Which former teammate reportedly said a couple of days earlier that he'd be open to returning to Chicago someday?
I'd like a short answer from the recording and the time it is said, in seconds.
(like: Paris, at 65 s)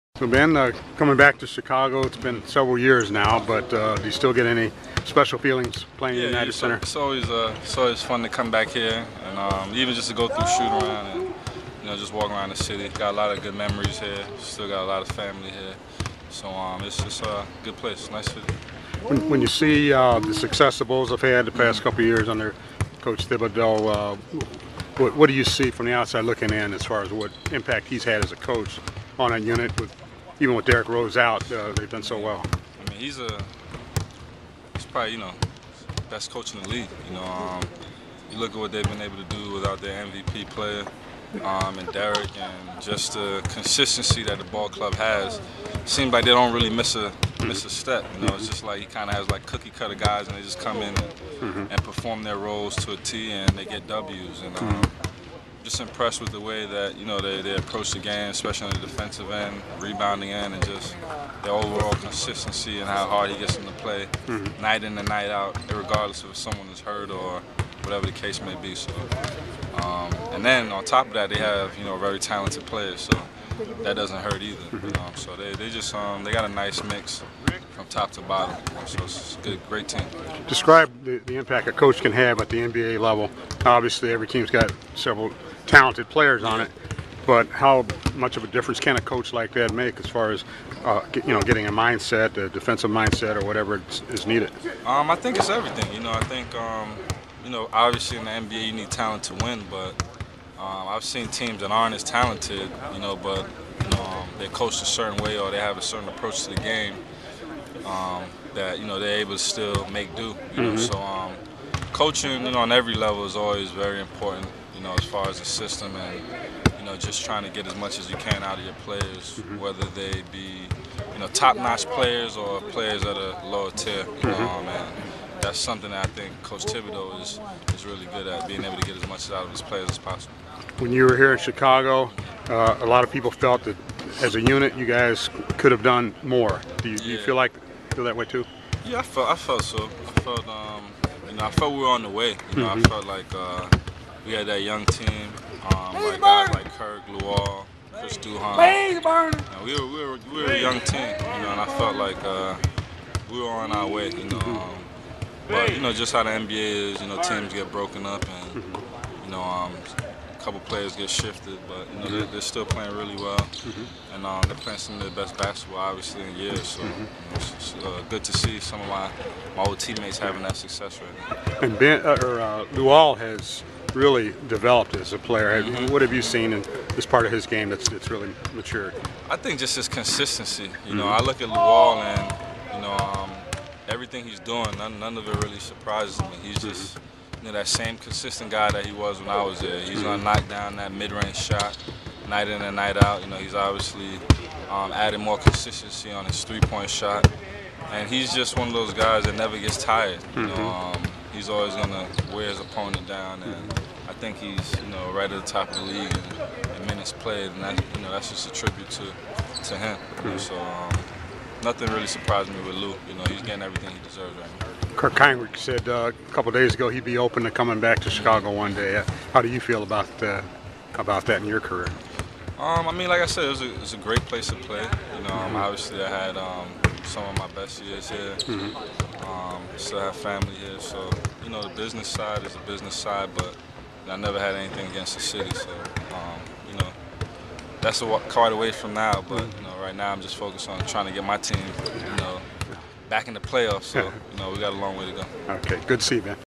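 Kirk Hinrich, at 214 s.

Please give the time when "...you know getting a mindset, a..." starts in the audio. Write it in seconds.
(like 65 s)
91 s.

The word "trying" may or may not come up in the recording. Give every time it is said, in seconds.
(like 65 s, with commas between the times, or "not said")
117 s, 240 s.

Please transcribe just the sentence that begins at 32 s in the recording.
I mean, he's a he's probably you know best coach in the league.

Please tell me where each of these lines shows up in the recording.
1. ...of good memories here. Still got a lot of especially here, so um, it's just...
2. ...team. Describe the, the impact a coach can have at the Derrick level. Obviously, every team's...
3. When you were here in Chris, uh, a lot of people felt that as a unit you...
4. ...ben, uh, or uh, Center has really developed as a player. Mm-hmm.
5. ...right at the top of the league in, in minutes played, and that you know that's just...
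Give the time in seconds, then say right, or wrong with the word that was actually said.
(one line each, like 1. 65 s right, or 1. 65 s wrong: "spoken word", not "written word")
1. 13 s wrong: "family", not "especially"
2. 79 s wrong: "NBA", not "Derrick"
3. 130 s wrong: "Chicago", not "Chris"
4. 171 s wrong: "Luol", not "Center"
5. 205 s right.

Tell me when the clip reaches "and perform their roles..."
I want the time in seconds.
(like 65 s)
51 s.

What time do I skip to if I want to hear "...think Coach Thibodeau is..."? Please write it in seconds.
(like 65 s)
126 s.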